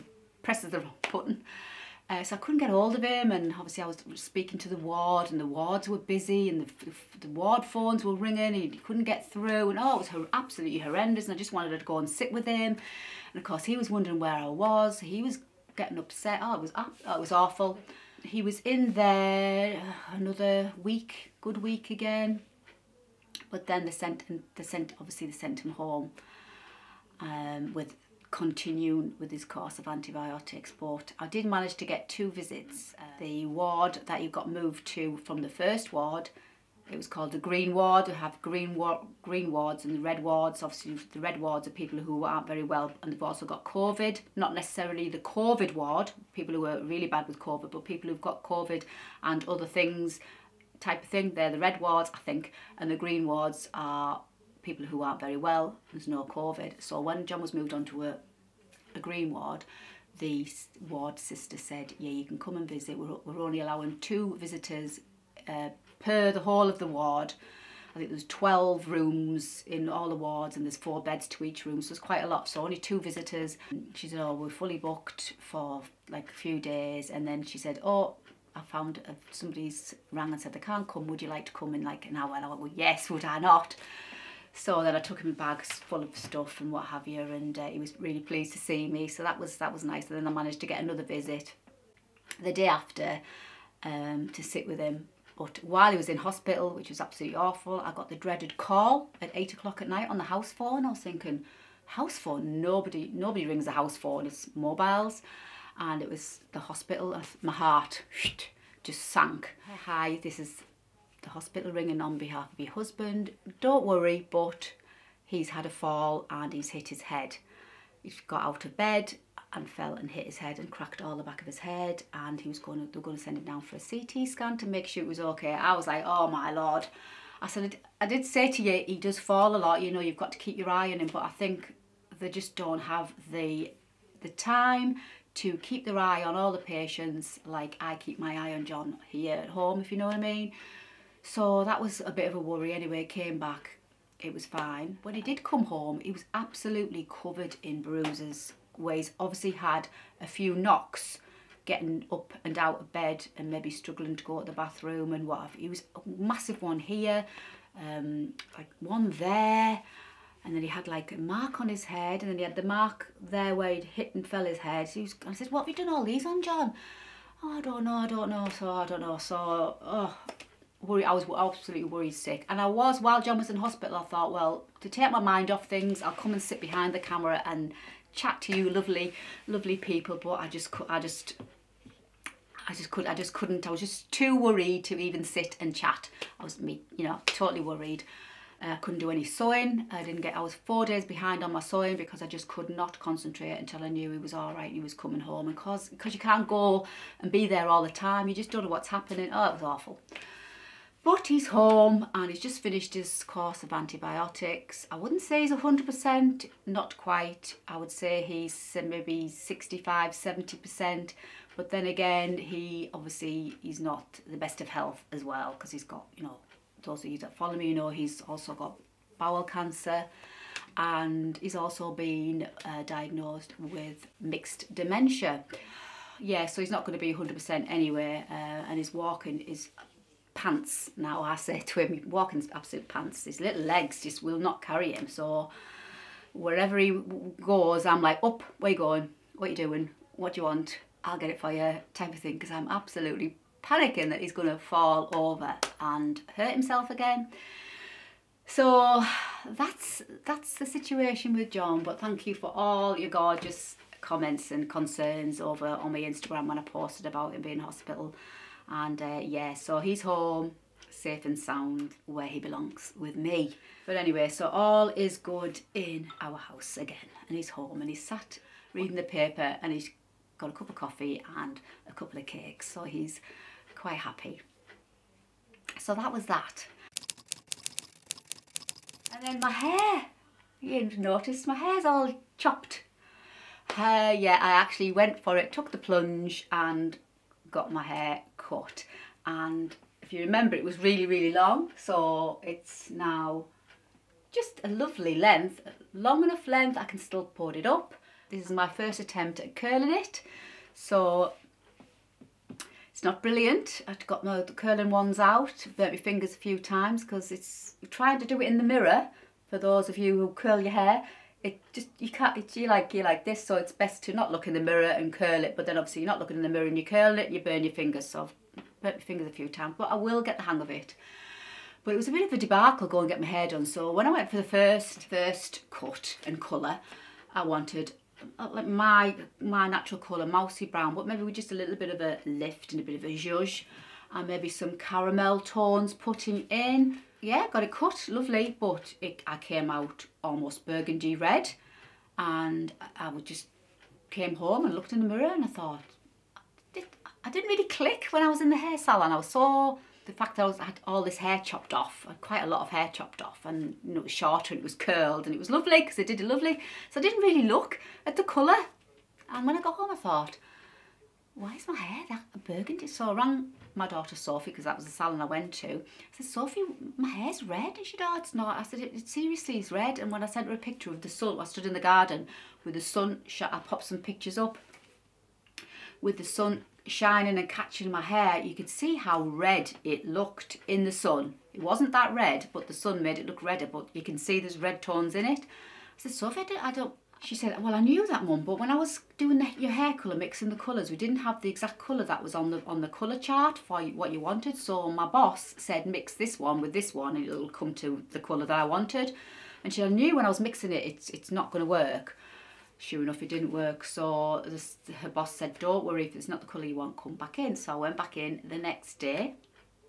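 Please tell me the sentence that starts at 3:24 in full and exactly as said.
I wouldn't say he's 100%, not quite.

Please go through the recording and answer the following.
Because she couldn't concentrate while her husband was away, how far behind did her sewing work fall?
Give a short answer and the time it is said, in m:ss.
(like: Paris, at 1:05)
4 days, at 3:10.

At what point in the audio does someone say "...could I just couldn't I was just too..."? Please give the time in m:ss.
3:02.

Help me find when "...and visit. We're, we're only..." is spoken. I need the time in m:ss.
1:02.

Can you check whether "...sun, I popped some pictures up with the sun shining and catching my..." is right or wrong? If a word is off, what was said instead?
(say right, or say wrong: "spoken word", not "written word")
right.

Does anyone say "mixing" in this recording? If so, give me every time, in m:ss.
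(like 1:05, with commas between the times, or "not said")
6:30, 6:40.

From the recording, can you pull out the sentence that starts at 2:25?
When he did come home, he was absolutely covered in bruises ways.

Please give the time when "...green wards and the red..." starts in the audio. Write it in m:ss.
0:39.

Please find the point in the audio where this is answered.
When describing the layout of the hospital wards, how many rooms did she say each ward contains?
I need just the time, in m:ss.
1:08.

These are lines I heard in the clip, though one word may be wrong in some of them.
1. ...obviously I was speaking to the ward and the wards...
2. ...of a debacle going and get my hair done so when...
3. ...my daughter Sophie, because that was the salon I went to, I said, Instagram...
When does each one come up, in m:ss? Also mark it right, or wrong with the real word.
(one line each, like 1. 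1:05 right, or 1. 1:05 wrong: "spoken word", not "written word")
1. 0:03 right
2. 5:22 right
3. 6:03 wrong: "Sophie", not "Instagram".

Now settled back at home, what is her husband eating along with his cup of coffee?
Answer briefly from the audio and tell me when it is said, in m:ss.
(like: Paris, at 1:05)
A couple of cakes, at 4:31.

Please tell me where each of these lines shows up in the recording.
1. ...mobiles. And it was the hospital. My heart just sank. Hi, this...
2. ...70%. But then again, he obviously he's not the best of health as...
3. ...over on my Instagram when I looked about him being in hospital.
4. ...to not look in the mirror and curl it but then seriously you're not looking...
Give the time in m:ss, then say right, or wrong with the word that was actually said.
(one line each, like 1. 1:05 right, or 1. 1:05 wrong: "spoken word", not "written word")
1. 1:44 right
2. 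3:30 right
3. 4:15 wrong: "posted", not "looked"
4. 5:14 wrong: "obviously", not "seriously".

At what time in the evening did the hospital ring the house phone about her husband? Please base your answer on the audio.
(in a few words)
8 o'clock.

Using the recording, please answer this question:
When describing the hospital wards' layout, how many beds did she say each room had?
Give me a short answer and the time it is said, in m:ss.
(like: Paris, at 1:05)
4, at 1:10.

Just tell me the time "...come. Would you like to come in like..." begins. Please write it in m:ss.
1:20.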